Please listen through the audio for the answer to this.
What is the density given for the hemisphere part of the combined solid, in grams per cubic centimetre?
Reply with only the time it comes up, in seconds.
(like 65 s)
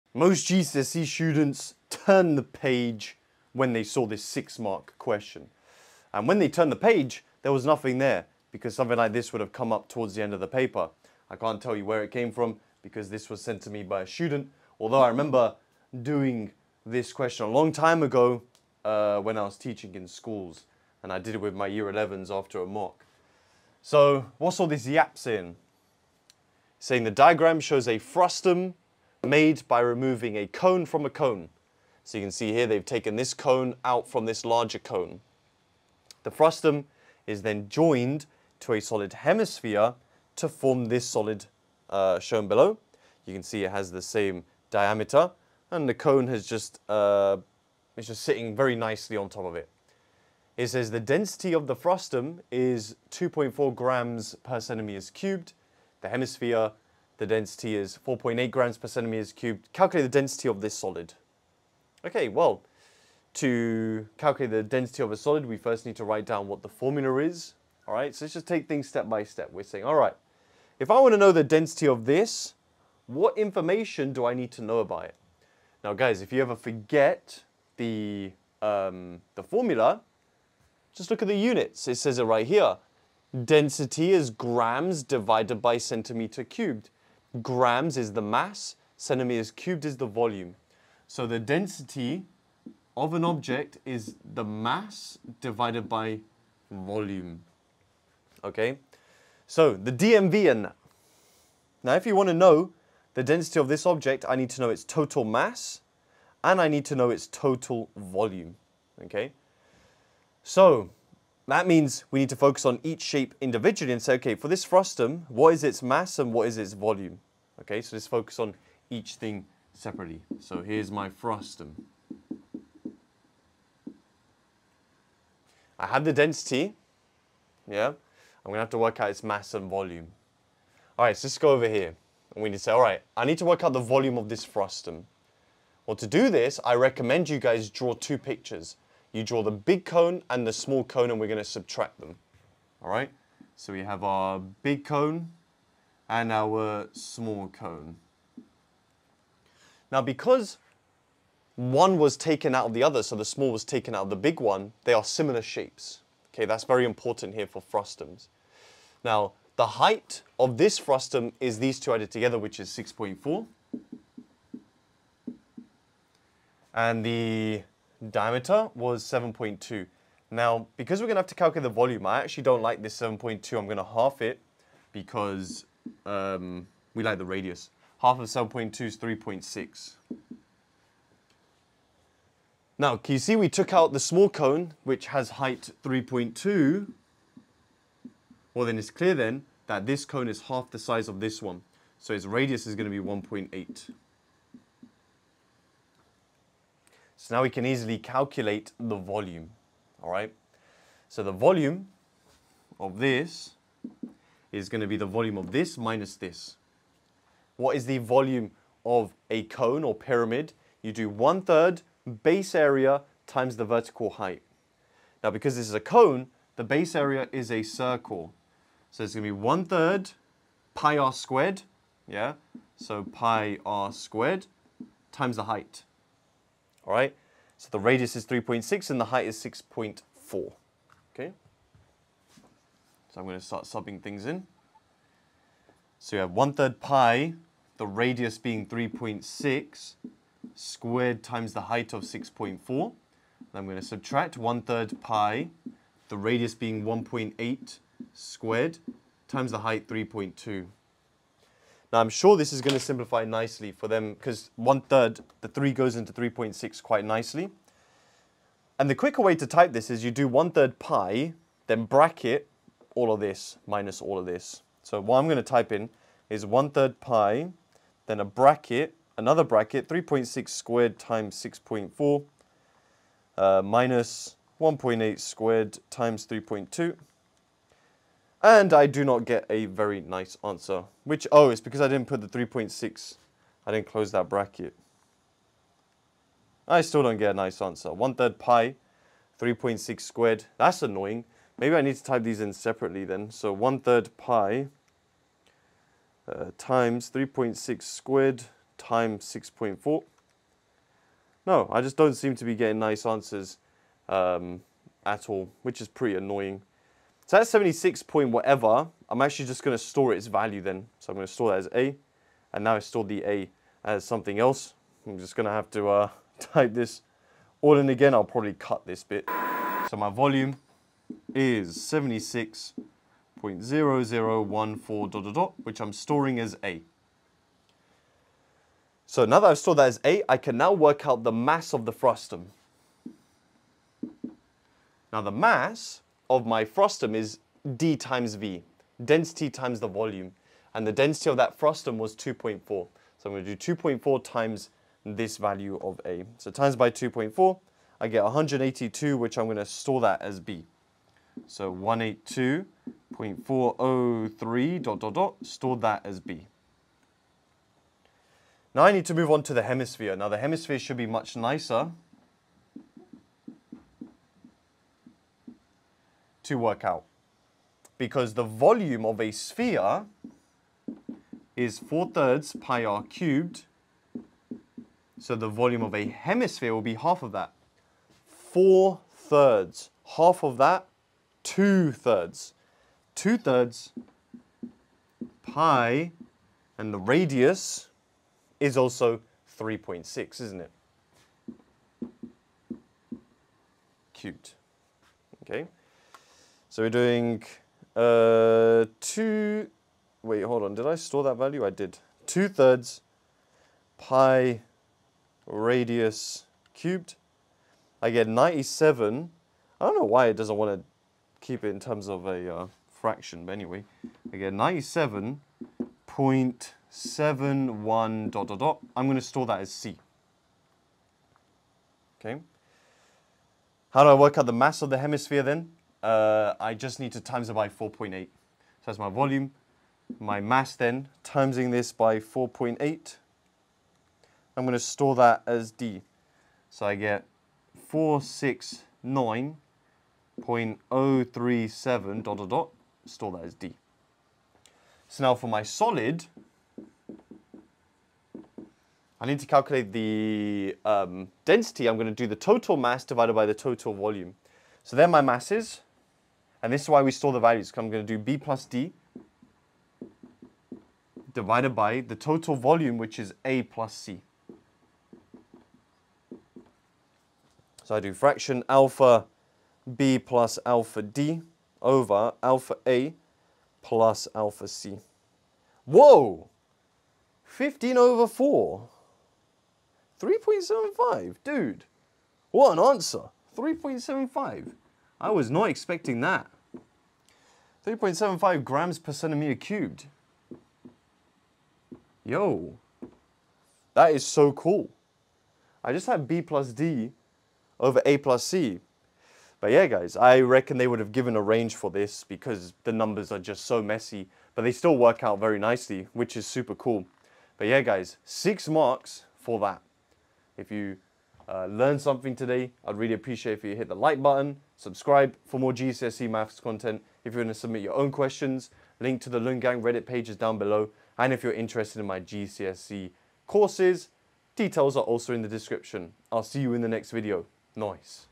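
58 s.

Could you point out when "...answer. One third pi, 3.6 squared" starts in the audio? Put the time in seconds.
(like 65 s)
287 s.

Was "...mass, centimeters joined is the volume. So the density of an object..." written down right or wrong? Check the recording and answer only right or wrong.
wrong.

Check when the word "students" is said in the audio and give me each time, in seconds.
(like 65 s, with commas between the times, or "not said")
1 s, 14 s.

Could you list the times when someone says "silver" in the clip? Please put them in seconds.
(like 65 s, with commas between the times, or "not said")
not said.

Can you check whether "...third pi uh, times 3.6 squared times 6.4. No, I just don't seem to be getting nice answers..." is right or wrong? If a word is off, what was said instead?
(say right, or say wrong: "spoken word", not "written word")
right.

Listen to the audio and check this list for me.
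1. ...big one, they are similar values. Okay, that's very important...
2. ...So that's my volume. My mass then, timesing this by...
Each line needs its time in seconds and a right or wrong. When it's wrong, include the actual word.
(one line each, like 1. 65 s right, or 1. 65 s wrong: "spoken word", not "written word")
1. 154 s wrong: "shapes", not "values"
2. 428 s right.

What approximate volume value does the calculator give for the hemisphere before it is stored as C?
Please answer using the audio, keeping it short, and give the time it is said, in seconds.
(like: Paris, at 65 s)
97.71, at 414 s.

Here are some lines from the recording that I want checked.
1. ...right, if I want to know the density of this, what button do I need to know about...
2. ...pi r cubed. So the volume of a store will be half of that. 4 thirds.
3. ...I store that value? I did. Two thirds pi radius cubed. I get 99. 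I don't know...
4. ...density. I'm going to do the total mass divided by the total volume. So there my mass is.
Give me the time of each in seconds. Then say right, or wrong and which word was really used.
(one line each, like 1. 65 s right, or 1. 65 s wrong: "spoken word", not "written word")
1. 69 s wrong: "information", not "button"
2. 372 s wrong: "hemisphere", not "store"
3. 400 s wrong: "97", not "99"
4. 451 s right.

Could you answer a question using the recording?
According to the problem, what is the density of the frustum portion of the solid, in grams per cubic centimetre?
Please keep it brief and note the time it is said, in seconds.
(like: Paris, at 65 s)
2.4, at 53 s.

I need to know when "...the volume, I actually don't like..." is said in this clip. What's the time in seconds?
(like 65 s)
171 s.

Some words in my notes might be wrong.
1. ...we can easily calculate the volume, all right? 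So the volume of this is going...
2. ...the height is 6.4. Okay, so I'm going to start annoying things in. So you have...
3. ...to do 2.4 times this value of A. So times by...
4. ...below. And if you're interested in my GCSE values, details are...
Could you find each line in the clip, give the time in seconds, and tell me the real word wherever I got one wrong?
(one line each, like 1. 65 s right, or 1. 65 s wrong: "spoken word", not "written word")
1. 197 s right
2. 228 s wrong: "subbing", not "annoying"
3. 343 s right
4. 520 s wrong: "courses", not "values".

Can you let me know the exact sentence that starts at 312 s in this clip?
And now I store the A as something else.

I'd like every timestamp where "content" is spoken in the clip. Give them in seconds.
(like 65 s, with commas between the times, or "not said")
516 s.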